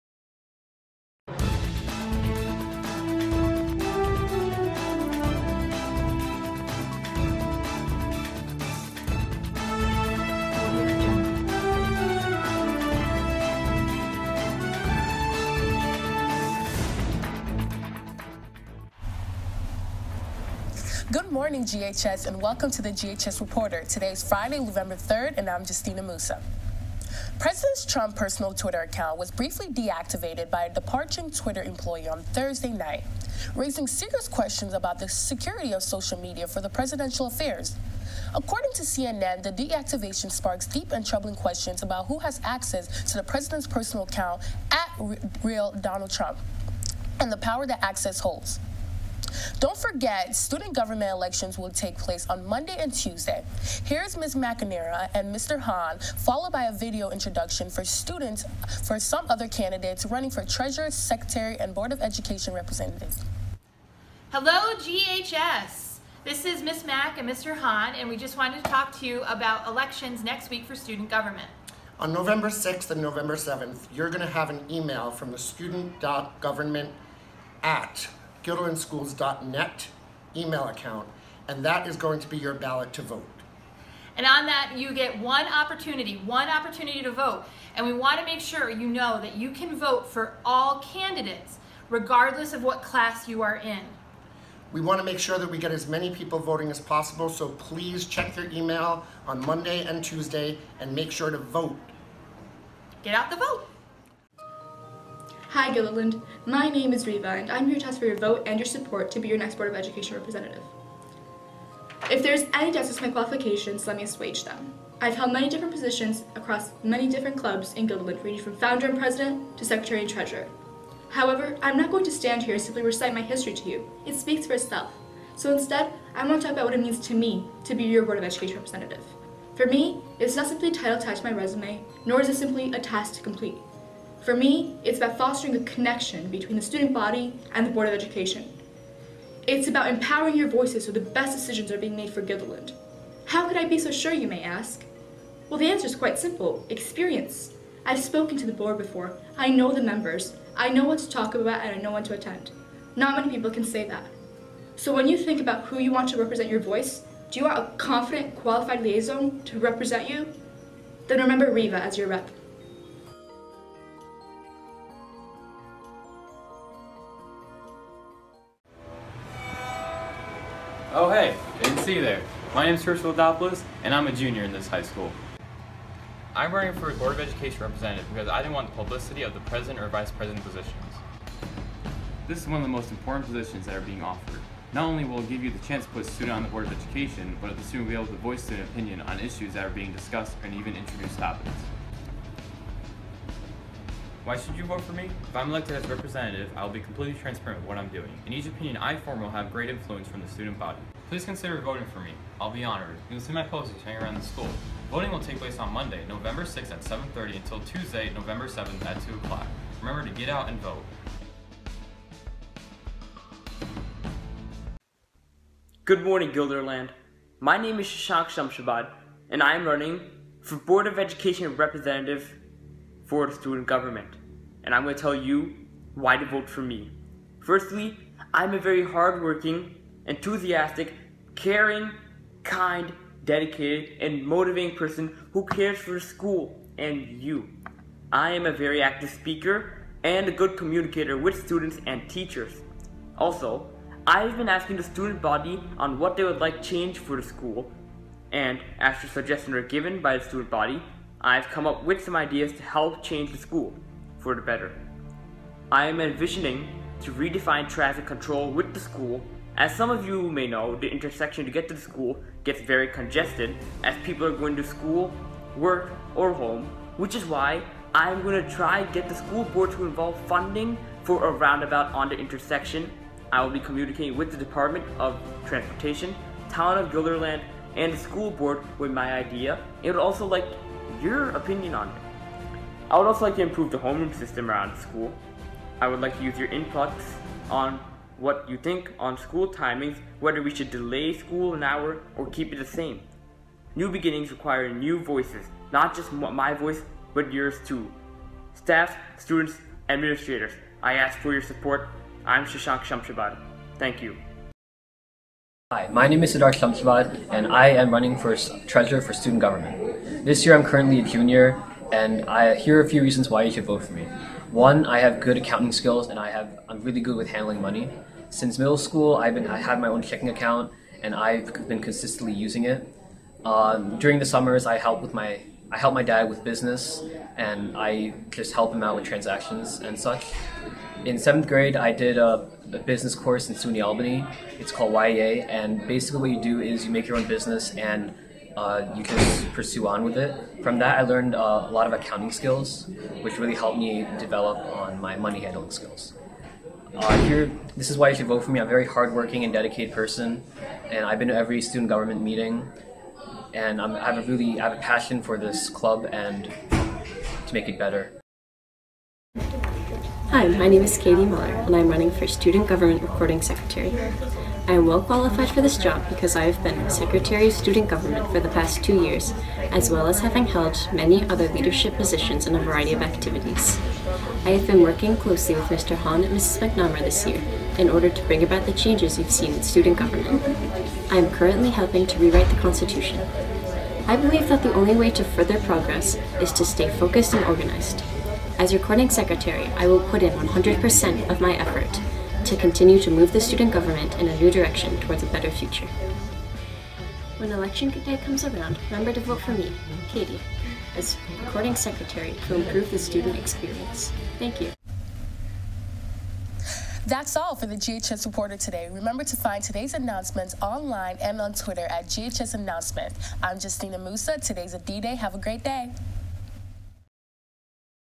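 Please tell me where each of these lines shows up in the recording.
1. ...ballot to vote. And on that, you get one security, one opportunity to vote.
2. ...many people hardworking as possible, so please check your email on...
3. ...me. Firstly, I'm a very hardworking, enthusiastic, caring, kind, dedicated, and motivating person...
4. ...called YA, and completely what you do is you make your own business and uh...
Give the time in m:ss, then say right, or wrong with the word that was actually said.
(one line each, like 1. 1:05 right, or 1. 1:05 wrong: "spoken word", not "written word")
1. 1:22 wrong: "opportunity", not "security"
2. 1:35 wrong: "voting", not "hardworking"
3. 3:46 right
4. 5:34 wrong: "basically", not "completely".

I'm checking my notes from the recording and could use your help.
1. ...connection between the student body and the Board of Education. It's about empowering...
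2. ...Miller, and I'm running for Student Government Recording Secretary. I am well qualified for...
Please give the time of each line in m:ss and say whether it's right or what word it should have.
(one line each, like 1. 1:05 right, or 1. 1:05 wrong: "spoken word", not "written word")
1. 2:15 right
2. 6:01 right.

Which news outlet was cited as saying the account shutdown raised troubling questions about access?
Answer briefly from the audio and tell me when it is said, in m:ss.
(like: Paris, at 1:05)
CNN, at 0:38.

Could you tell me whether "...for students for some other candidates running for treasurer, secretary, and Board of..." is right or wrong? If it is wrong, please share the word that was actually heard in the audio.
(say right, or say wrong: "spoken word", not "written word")
right.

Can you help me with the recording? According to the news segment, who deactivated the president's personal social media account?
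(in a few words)
Departing Twitter employee.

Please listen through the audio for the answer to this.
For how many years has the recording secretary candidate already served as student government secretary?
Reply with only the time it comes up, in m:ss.
6:08.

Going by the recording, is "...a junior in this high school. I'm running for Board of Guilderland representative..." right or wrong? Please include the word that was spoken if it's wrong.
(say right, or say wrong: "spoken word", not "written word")
wrong: "Education", not "Guilderland".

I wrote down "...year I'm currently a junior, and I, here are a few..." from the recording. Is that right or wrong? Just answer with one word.
right.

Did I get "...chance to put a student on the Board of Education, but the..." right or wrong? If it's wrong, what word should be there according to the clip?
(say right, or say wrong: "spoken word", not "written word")
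right.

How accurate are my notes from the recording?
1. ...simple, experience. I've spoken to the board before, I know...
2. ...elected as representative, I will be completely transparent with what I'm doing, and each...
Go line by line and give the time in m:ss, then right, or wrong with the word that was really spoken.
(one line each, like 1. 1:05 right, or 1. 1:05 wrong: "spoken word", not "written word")
1. 2:26 right
2. 3:15 right.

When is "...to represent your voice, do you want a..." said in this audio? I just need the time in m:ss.
2:36.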